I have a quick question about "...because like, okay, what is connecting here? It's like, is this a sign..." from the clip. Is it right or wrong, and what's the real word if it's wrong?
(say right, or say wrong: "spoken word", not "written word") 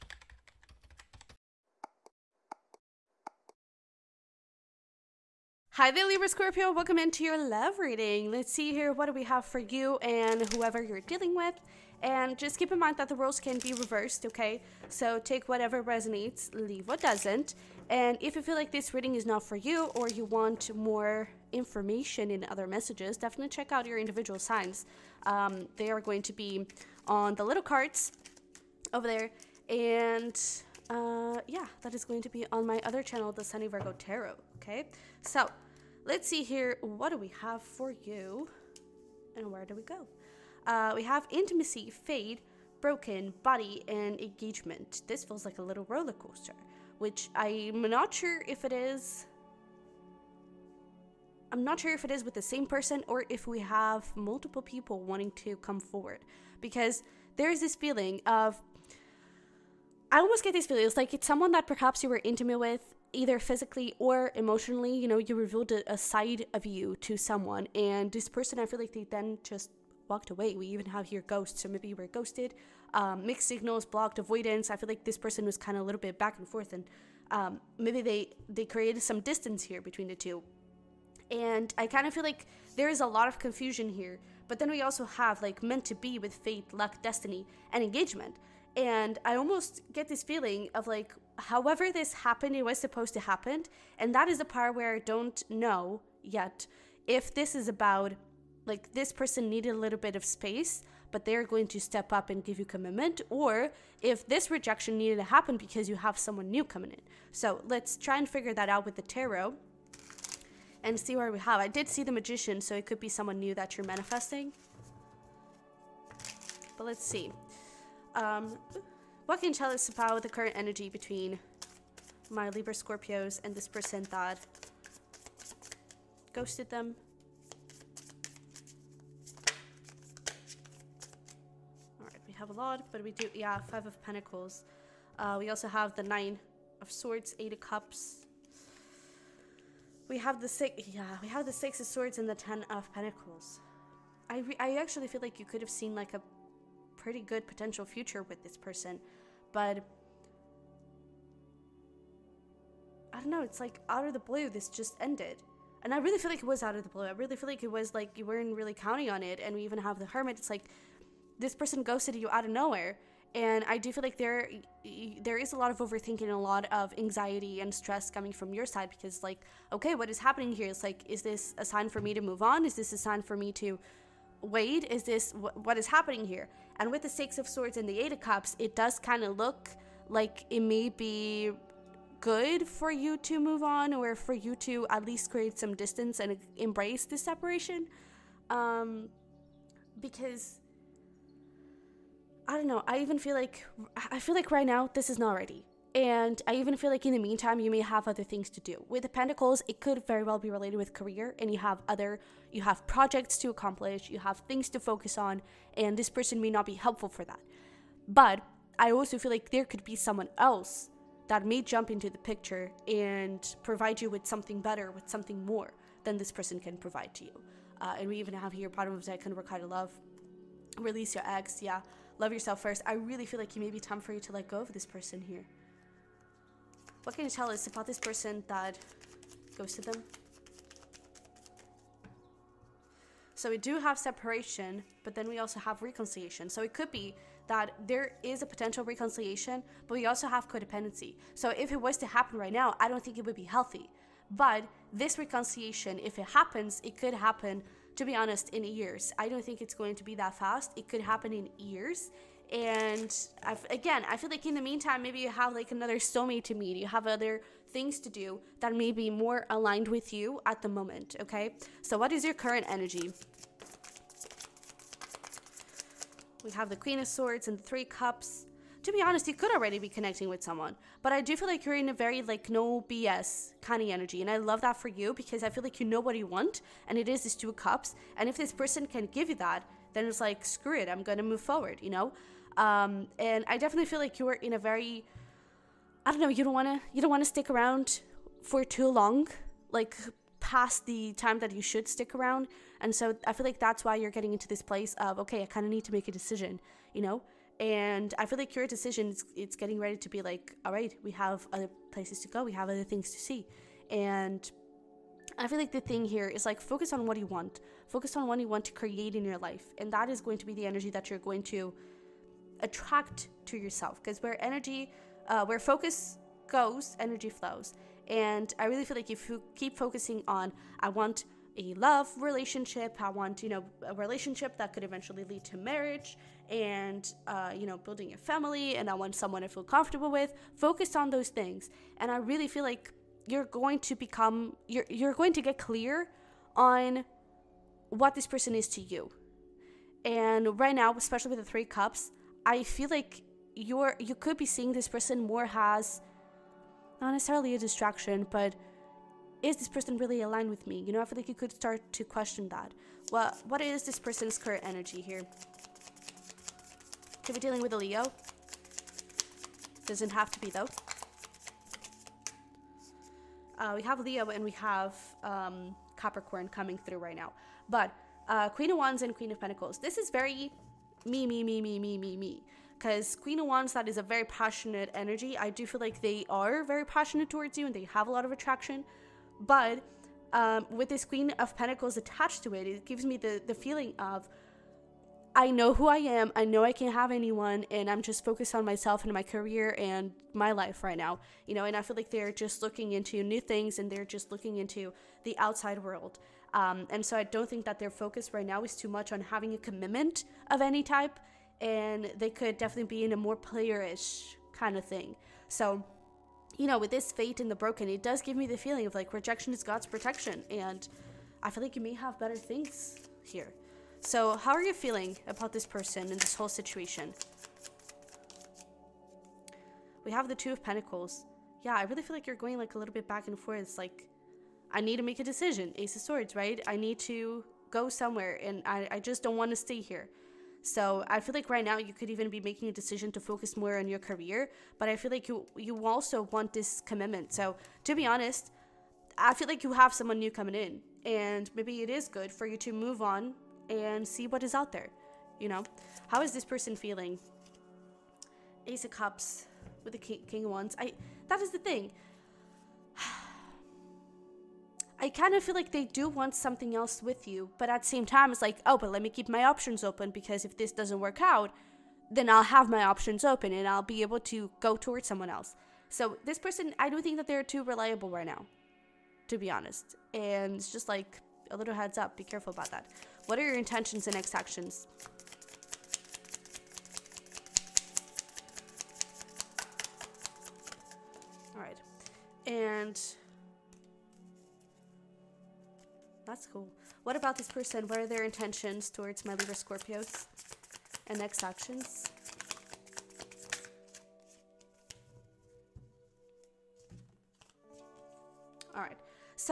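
wrong: "happening", not "connecting".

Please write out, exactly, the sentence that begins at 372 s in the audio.
Because Queen of Wands, that is a very passionate energy.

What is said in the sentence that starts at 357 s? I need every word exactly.
Could be dealing with a Leo.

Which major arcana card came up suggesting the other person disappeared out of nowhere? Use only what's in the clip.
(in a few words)
The Hermit.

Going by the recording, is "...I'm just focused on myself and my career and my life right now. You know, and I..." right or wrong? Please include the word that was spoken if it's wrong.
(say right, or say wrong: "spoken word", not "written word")
right.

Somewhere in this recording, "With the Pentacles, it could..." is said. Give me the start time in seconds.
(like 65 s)
198 s.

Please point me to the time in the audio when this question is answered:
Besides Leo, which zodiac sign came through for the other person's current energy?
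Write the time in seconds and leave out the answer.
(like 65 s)
365 s.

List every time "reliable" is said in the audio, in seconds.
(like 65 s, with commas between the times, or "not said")
467 s.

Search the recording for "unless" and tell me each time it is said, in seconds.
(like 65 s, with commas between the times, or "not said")
not said.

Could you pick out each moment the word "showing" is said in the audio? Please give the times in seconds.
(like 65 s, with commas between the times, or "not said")
not said.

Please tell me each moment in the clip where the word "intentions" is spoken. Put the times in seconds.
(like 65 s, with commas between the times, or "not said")
473 s, 488 s.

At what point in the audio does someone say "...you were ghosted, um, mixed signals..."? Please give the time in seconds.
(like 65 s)
71 s.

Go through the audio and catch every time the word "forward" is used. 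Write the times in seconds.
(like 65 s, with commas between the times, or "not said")
55 s, 281 s.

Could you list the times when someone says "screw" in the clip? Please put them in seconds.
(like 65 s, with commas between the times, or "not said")
280 s.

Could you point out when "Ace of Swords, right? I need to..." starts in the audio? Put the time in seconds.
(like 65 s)
425 s.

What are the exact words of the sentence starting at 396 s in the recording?
Um, and so I don't think that their focus right now is too much on having a commitment of any type.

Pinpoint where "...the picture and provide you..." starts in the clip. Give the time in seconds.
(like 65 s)
212 s.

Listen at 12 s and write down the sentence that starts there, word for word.
And just keep in mind that the roles can be reversed, okay?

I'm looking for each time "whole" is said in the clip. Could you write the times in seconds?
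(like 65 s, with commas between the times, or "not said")
416 s.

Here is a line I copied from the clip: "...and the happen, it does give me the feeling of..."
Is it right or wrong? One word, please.
wrong.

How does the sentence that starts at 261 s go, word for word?
So, what is your current energy?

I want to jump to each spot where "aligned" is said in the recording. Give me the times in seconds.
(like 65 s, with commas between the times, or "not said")
259 s, 350 s.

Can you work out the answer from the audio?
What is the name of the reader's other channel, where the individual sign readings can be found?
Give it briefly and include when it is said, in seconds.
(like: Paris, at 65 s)
Sunny Virgo Tarot, at 33 s.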